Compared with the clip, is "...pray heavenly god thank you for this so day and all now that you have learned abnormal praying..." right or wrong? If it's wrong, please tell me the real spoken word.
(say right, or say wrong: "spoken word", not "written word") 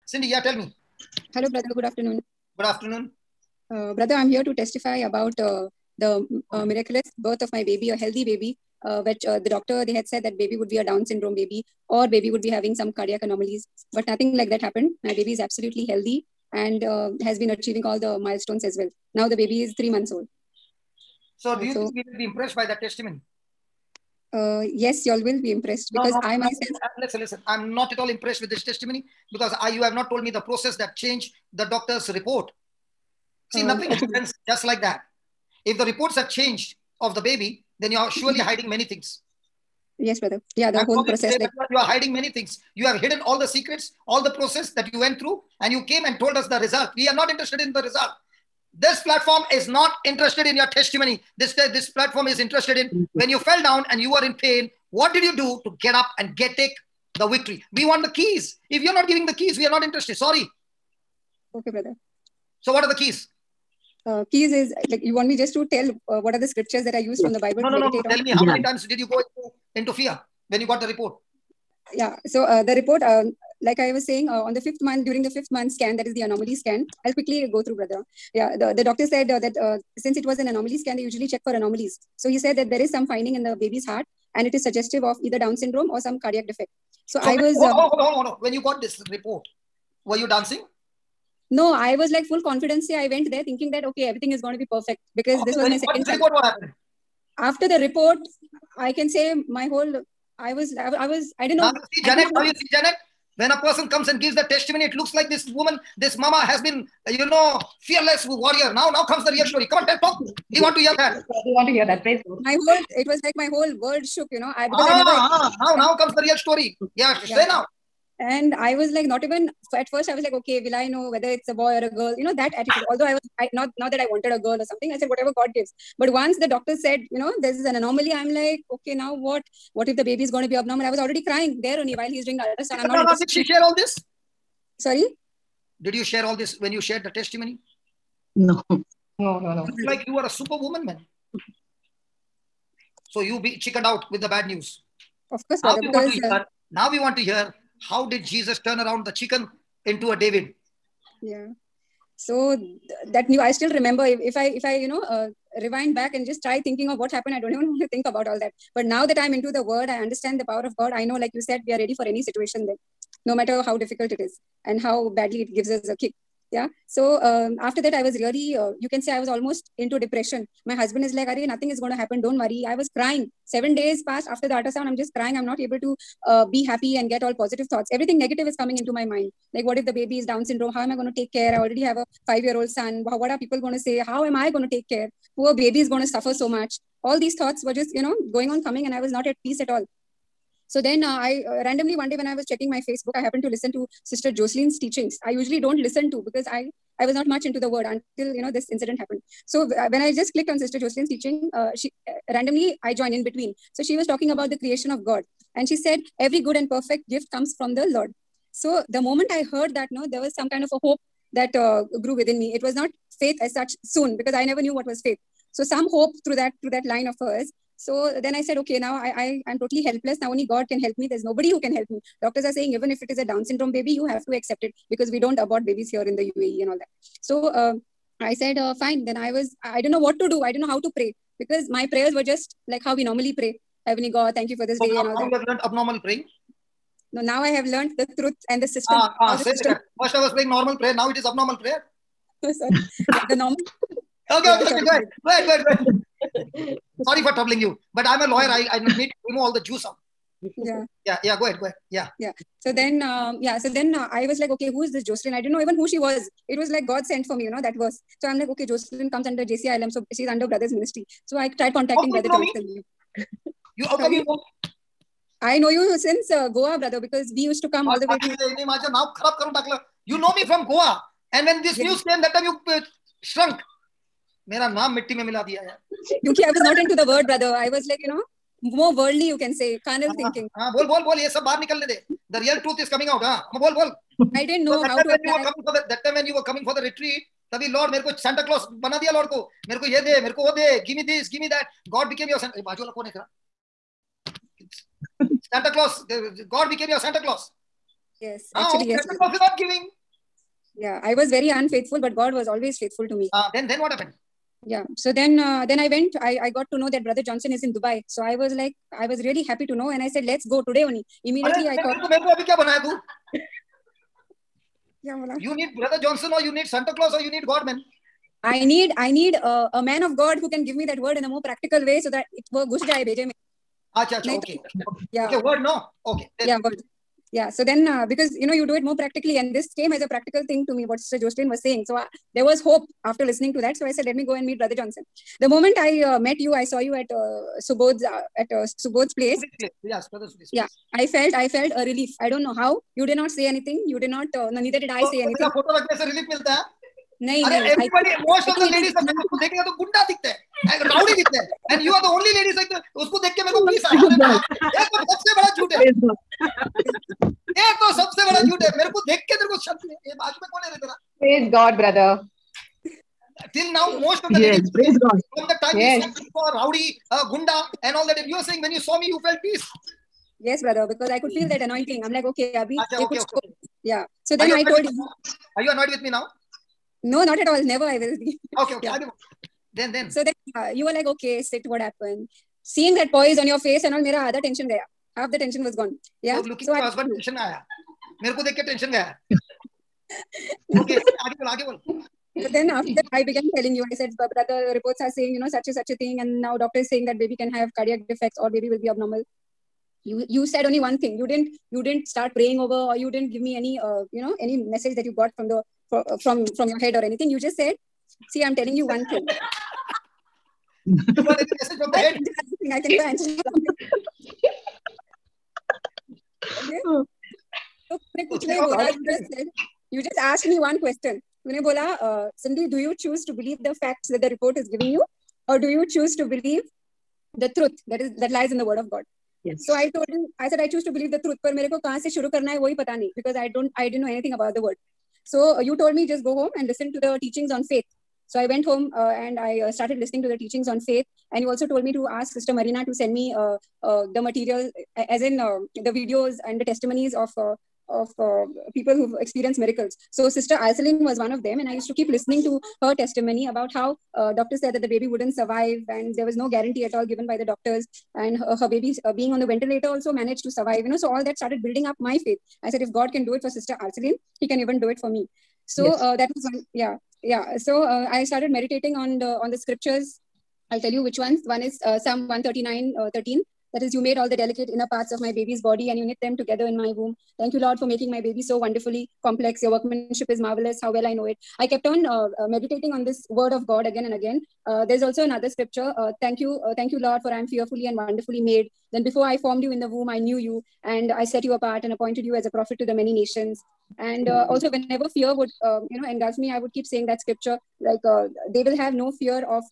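right.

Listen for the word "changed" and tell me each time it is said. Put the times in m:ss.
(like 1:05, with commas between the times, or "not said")
0:30, 0:36.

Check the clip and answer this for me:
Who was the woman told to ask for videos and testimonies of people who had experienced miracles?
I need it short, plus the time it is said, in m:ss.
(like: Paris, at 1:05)
Sister Marina, at 7:22.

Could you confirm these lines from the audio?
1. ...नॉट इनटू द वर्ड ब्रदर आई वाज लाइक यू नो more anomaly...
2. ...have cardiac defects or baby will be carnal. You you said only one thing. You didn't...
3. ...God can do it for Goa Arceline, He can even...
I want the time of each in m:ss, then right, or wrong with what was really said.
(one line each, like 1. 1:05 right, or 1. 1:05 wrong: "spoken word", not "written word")
1. 4:36 wrong: "worldly", not "anomaly"
2. 6:37 wrong: "abnormal", not "carnal"
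3. 7:42 wrong: "Sister", not "Goa".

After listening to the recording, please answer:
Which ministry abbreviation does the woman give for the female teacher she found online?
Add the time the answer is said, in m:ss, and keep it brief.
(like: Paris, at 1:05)
JCILM, at 4:19.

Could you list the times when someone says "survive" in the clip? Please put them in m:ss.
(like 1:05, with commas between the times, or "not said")
7:35, 7:40.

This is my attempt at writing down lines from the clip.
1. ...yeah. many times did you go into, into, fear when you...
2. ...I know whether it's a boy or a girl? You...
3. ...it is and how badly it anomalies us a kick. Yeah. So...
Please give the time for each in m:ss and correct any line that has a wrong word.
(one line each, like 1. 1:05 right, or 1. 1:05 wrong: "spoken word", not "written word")
1. 1:08 right
2. 2:00 right
3. 2:44 wrong: "gives", not "anomalies".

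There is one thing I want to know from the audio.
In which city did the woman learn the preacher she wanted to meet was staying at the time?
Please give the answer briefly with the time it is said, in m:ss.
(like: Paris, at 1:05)
Dubai, at 5:07.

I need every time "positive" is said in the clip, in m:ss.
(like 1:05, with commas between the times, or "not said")
2:57.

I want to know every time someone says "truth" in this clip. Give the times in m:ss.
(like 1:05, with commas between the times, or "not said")
3:58, 4:42, 7:11.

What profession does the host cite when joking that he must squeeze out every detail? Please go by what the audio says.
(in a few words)
Lawyer.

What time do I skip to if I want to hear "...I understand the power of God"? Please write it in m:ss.
2:39.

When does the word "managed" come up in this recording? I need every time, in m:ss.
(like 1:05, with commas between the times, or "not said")
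7:40.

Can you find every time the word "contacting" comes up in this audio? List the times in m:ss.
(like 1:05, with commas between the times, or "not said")
4:21.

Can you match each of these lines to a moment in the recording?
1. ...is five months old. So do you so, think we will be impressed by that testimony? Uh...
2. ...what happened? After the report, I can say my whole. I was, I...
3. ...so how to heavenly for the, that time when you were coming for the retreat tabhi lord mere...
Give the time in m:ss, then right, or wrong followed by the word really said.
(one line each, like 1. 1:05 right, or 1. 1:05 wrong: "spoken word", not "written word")
1. 0:19 wrong: "three", not "five"
2. 1:36 right
3. 4:44 wrong: "apply", not "heavenly".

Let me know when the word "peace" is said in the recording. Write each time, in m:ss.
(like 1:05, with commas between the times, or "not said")
3:09, 6:09.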